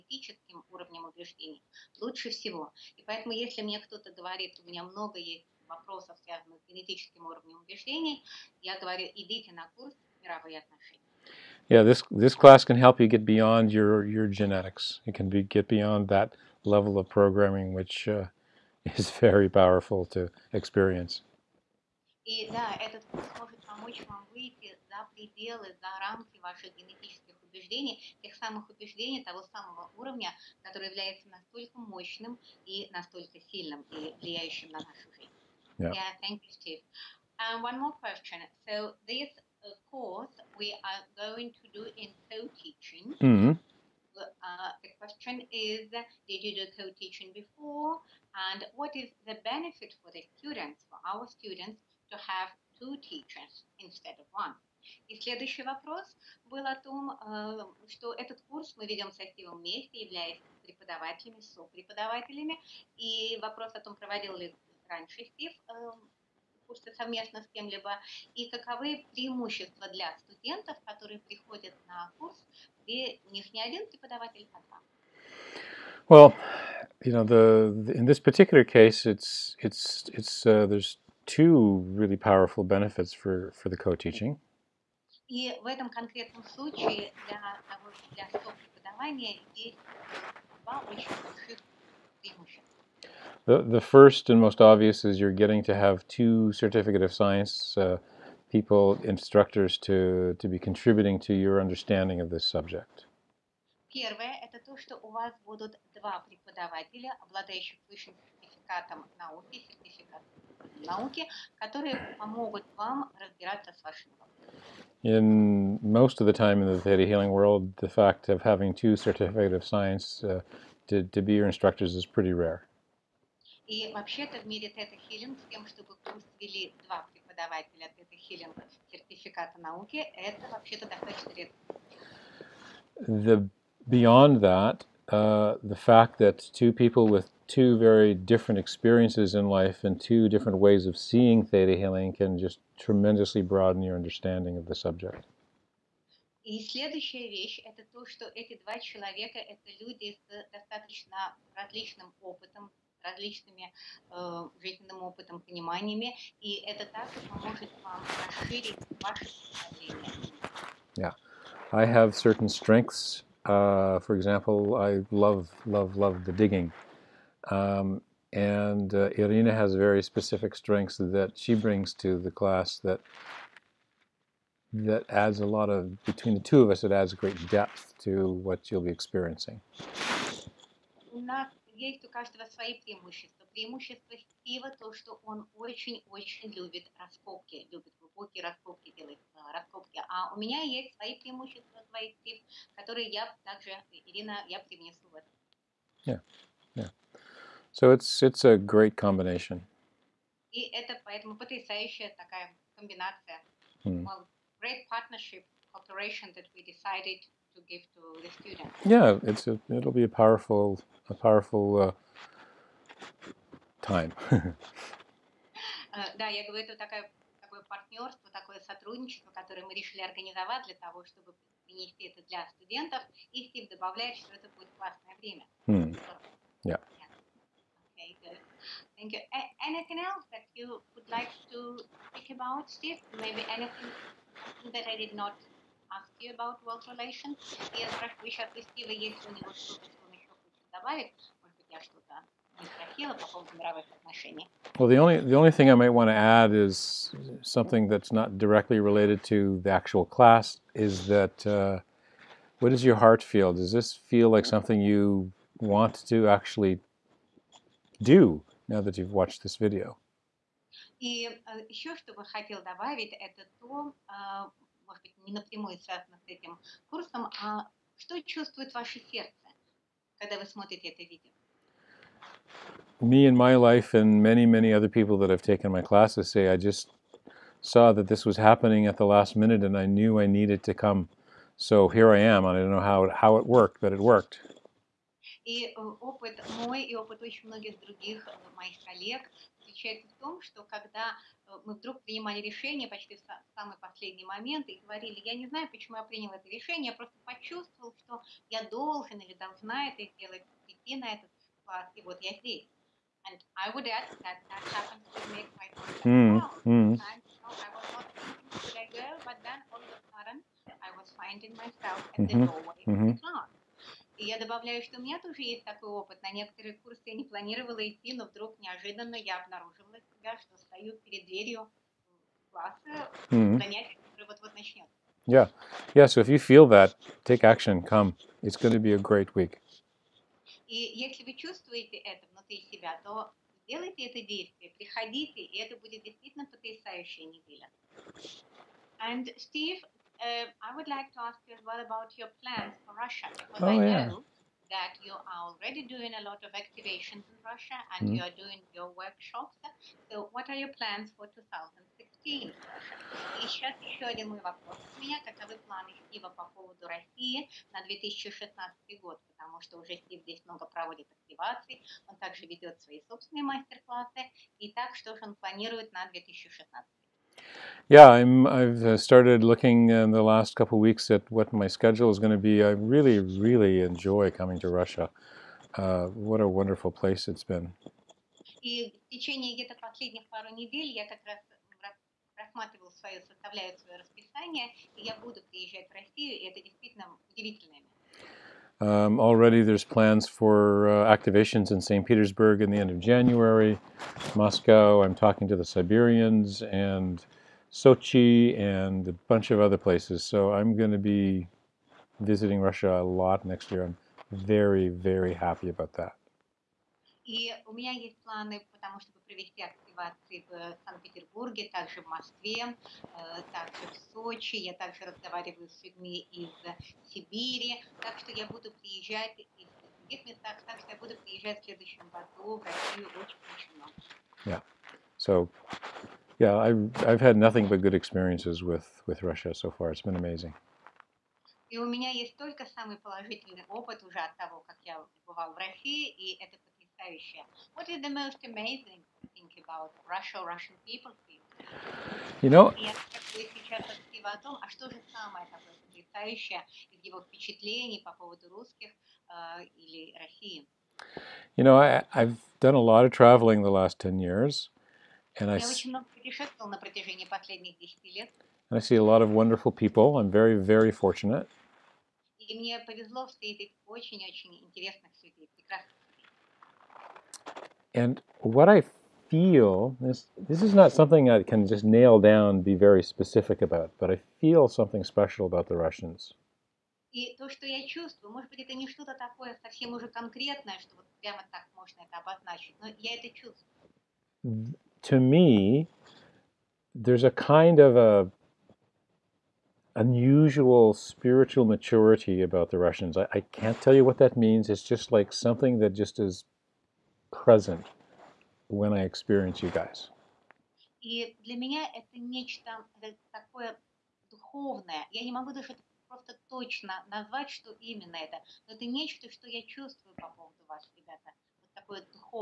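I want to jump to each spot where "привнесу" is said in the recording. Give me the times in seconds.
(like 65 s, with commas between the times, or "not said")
194 s.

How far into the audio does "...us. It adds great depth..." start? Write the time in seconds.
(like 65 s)
176 s.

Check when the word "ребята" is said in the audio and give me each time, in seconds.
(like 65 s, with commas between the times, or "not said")
510 s.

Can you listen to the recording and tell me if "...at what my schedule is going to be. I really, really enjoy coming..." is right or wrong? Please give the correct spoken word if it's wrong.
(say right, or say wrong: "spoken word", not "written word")
right.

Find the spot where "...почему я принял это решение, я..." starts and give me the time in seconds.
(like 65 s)
295 s.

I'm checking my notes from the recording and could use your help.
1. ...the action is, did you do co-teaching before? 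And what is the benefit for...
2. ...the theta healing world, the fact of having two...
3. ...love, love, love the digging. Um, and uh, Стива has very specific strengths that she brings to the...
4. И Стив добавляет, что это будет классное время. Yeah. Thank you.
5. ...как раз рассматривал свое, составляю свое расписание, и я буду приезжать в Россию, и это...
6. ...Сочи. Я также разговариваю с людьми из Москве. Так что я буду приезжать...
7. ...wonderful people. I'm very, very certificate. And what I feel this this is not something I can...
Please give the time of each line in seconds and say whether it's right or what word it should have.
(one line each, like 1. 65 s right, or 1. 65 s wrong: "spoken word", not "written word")
1. 44 s wrong: "question", not "action"
2. 116 s right
3. 165 s wrong: "Irina", not "Стива"
4. 223 s right
5. 381 s right
6. 414 s wrong: "Сибири", not "Москве"
7. 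459 s wrong: "fortunate", not "certificate".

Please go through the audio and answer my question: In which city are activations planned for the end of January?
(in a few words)
St. Petersburg.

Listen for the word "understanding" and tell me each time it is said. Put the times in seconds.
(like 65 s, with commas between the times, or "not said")
101 s, 143 s.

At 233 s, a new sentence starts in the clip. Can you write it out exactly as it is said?
Maybe anything that I did not ask you about world relations?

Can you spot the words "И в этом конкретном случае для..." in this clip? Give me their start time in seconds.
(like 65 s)
85 s.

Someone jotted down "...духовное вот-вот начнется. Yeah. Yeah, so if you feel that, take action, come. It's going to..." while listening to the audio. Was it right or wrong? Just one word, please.
wrong.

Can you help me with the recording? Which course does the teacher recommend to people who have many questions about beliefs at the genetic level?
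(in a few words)
World Relations.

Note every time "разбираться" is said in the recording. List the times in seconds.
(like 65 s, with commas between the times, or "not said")
113 s.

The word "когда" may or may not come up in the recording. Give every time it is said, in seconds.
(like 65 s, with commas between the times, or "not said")
270 s, 290 s.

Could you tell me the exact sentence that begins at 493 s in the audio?
I, I can't tell you what that means.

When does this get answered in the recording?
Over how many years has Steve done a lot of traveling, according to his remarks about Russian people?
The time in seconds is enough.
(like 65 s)
453 s.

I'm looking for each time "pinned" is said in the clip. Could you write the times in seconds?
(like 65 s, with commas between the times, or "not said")
not said.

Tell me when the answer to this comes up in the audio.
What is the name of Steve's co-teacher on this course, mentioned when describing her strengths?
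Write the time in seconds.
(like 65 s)
194 s.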